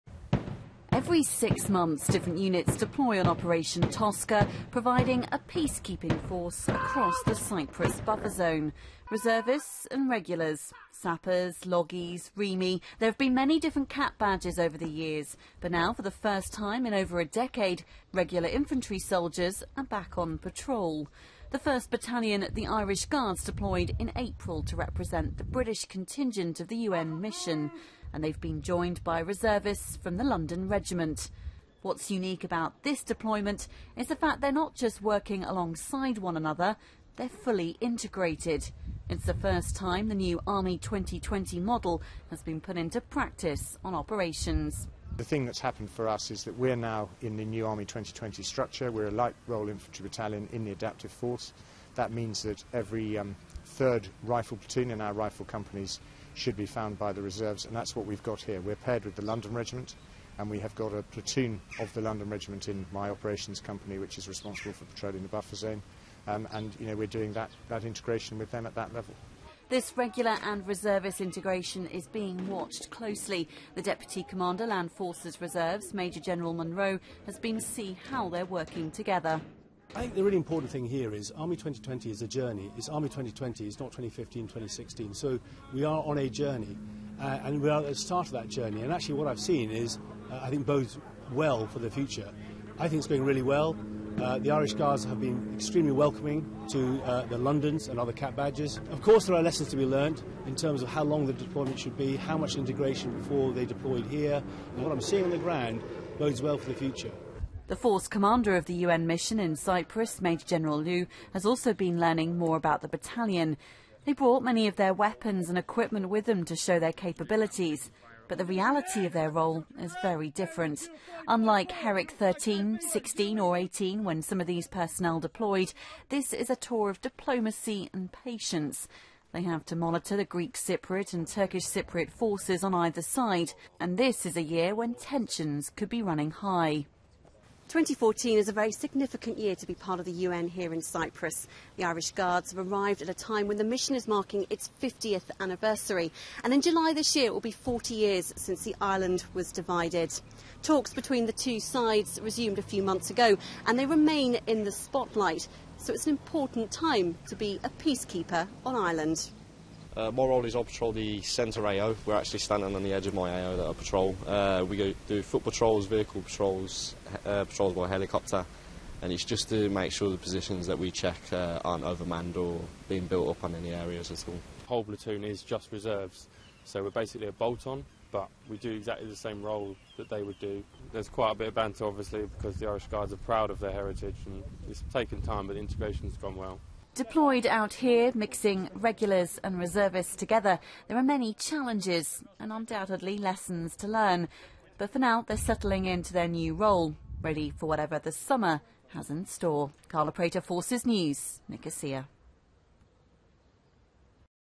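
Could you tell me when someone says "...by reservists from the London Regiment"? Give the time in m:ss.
0:29.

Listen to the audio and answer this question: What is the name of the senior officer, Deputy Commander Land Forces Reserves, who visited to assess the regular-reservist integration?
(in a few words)
Major General Munro.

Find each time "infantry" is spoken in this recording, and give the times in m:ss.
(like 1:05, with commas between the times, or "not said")
0:18, 0:49.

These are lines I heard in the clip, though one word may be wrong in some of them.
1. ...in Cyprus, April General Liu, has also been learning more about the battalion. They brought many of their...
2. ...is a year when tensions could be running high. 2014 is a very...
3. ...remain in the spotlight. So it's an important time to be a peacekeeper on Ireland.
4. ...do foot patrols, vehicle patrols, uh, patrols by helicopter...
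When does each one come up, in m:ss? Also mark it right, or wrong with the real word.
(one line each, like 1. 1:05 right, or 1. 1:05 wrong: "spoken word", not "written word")
1. 1:49 wrong: "Major", not "April"
2. 2:14 right
3. 2:33 right
4. 2:45 right.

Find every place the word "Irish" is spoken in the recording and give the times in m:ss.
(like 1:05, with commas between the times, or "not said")
0:22, 1:34, 2:21, 3:02.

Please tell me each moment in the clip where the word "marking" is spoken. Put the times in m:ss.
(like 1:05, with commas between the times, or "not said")
2:24.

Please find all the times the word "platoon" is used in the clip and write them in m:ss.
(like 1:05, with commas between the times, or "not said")
0:54, 1:01, 2:54.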